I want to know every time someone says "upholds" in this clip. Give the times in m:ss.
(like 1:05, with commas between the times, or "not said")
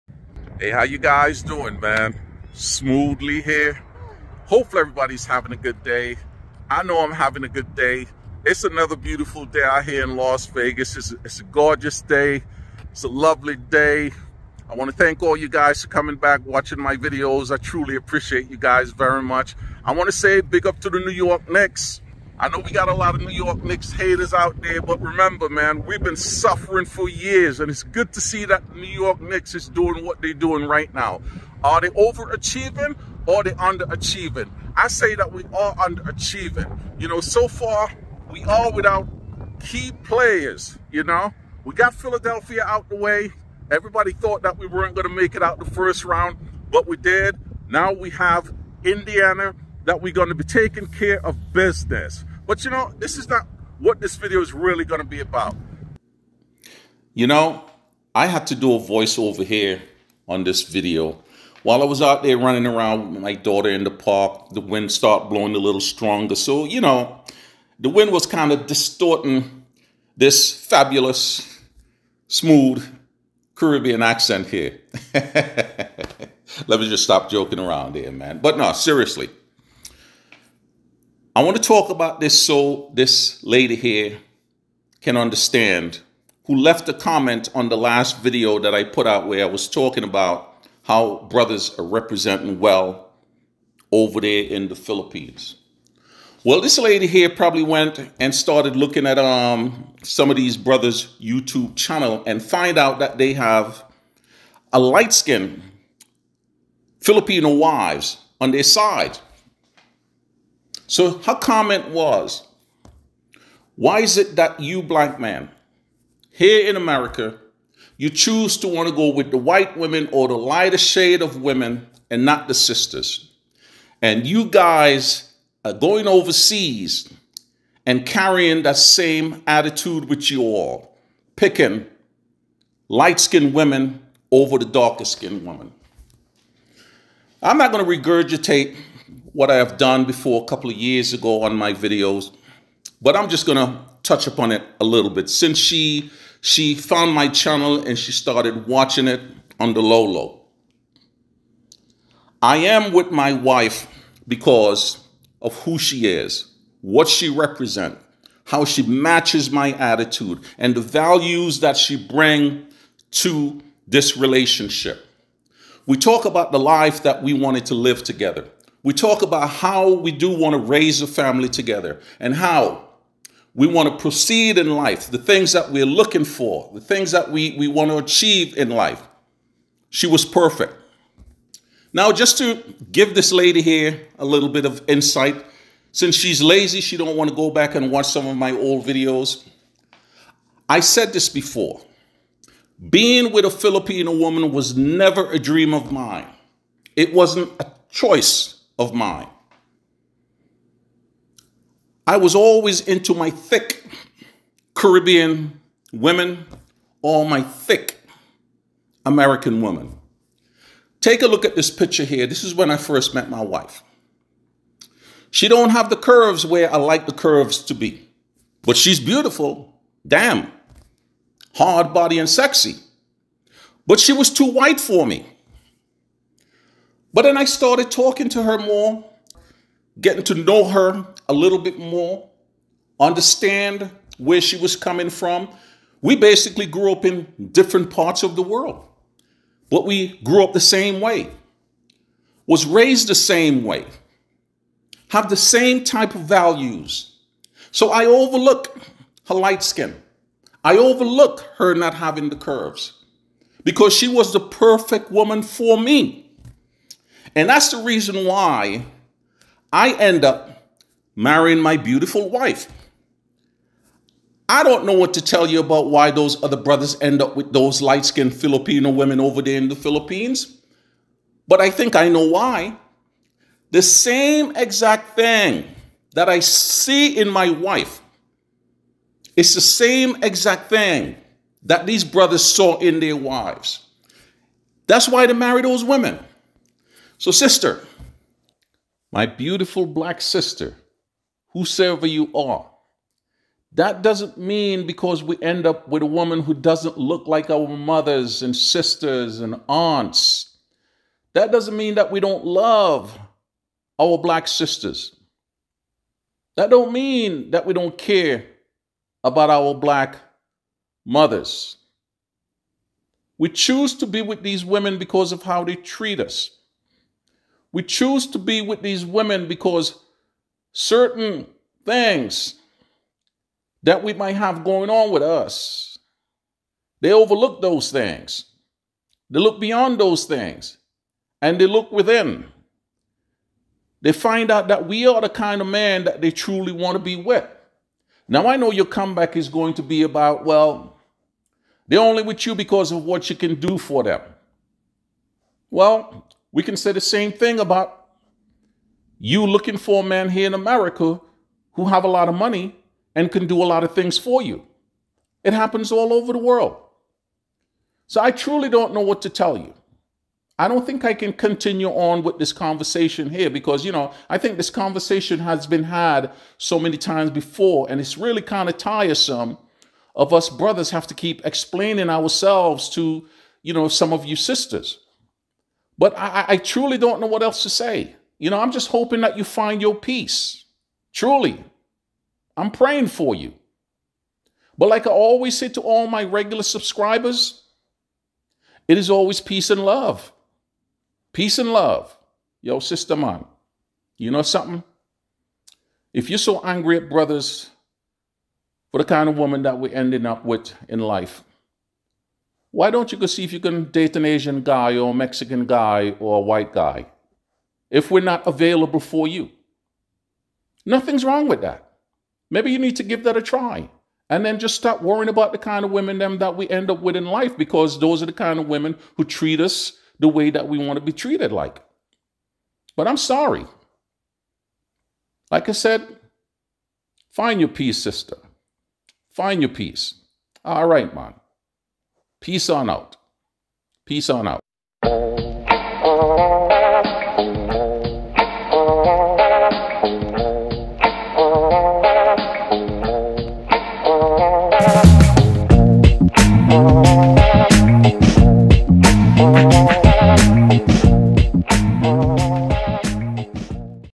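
not said.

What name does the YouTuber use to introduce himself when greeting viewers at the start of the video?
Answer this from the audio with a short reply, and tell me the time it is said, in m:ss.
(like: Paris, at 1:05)
Smooth Lee, at 0:02.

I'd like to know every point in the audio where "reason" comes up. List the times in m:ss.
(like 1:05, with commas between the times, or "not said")
4:17.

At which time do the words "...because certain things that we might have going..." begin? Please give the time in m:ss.
5:19.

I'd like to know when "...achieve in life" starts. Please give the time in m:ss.
2:57.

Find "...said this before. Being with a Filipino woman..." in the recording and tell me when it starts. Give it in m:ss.
3:10.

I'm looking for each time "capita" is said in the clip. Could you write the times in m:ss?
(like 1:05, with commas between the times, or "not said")
not said.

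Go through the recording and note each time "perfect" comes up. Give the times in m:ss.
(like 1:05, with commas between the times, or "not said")
3:00, 4:14.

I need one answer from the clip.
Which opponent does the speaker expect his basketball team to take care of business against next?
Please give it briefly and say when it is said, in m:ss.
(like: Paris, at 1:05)
Indiana, at 0:48.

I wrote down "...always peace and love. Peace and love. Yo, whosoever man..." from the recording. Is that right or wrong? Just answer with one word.
wrong.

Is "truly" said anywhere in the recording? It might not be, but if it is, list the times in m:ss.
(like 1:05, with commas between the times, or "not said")
0:17, 5:36, 5:58, 6:16, 6:21.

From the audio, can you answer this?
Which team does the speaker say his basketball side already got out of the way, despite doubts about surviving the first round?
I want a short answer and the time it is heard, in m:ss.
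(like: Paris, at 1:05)
Philadelphia, at 0:41.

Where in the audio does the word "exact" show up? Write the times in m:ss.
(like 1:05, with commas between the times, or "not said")
4:34, 4:40.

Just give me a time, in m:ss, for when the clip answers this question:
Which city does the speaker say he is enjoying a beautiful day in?
0:10.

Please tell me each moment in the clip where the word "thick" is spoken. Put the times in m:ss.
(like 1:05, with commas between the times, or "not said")
3:23, 3:27.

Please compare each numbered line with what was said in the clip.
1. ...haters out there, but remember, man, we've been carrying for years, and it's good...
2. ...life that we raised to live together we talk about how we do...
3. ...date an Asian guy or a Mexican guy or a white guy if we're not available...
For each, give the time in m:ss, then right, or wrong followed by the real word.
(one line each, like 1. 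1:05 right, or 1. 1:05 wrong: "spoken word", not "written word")
1. 0:23 wrong: "suffering", not "carrying"
2. 2:46 wrong: "wanted", not "raised"
3. 6:43 right.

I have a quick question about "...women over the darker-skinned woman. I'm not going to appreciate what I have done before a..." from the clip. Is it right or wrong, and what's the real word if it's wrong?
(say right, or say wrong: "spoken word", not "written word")
wrong: "regurgitate", not "appreciate".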